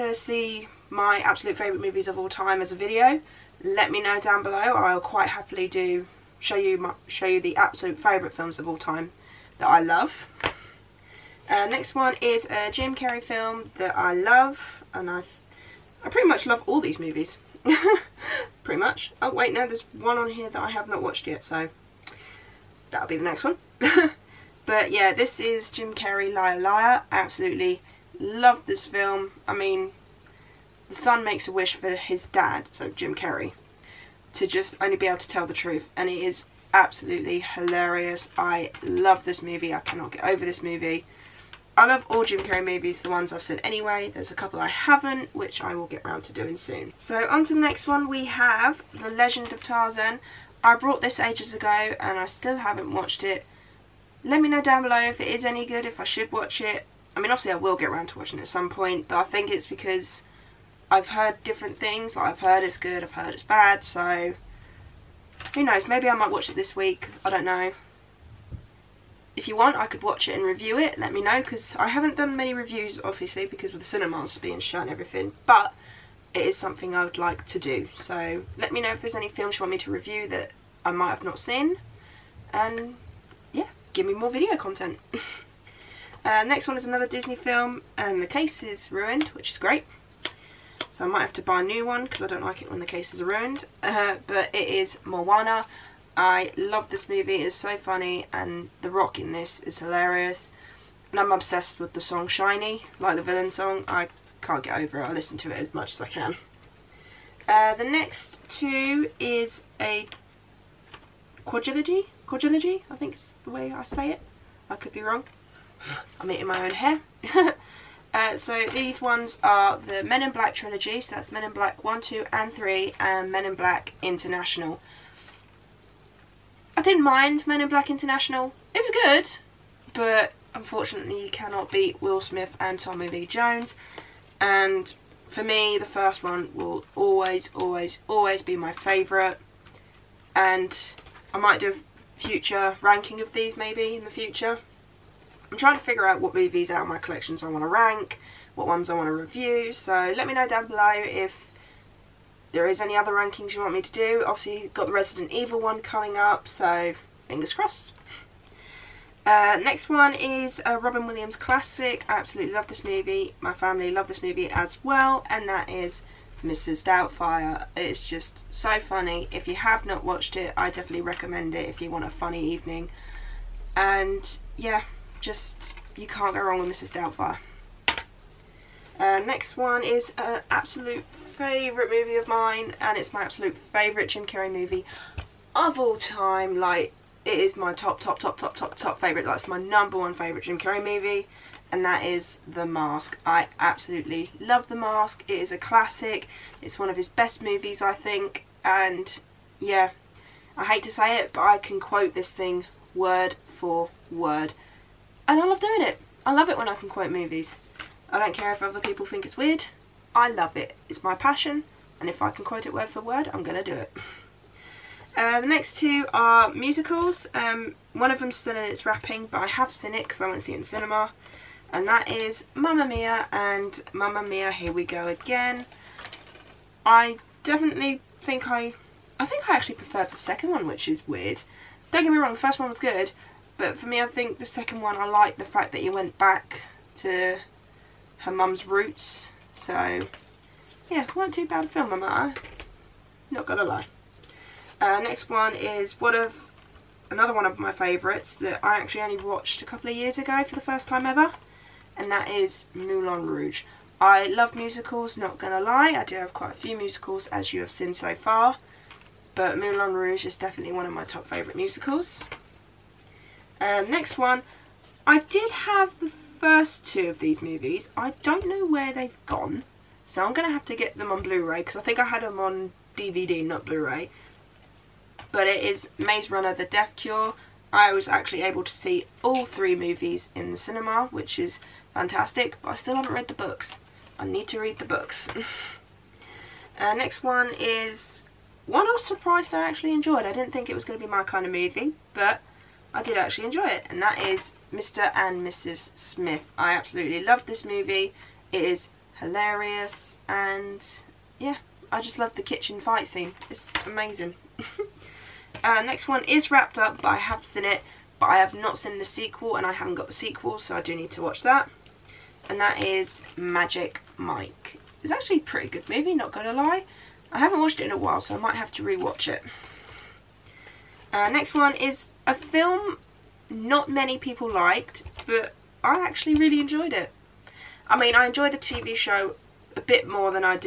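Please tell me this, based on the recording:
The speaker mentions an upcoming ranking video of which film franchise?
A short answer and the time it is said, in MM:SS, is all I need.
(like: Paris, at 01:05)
Resident Evil, at 02:34.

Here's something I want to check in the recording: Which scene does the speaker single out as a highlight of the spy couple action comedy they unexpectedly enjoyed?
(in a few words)
the kitchen fight scene.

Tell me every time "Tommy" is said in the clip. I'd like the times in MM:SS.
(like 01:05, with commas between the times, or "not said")
02:12.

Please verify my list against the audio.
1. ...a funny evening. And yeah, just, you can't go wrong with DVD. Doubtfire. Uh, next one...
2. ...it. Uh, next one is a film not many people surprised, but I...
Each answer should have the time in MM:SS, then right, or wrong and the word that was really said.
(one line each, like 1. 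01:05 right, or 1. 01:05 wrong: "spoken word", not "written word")
1. 02:52 wrong: "Mrs", not "DVD"
2. 05:19 wrong: "liked", not "surprised".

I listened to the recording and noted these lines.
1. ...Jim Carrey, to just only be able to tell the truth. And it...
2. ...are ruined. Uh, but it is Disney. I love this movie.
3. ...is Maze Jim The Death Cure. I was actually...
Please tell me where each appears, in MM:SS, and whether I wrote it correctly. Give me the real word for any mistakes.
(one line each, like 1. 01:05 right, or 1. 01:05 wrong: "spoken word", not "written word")
1. 00:32 right
2. 01:33 wrong: "Moana", not "Disney"
3. 04:35 wrong: "Runner", not "Jim".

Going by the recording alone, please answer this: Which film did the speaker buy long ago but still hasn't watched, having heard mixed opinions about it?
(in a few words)
The Legend of Tarzan.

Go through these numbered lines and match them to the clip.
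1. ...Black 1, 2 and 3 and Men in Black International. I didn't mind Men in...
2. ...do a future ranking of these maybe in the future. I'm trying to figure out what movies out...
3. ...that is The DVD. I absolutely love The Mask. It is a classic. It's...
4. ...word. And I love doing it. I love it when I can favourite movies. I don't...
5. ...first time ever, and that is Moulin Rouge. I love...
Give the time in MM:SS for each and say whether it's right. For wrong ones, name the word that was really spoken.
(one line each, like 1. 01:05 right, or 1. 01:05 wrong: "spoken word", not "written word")
1. 02:01 right
2. 02:21 right
3. 03:11 wrong: "Mask", not "DVD"
4. 03:24 wrong: "quote", not "favourite"
5. 04:10 right.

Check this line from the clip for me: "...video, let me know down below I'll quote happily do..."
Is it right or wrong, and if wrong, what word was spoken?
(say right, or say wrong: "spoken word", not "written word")
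wrong: "quite", not "quote".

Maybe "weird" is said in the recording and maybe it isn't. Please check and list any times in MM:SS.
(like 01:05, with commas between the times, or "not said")
03:29, 03:51.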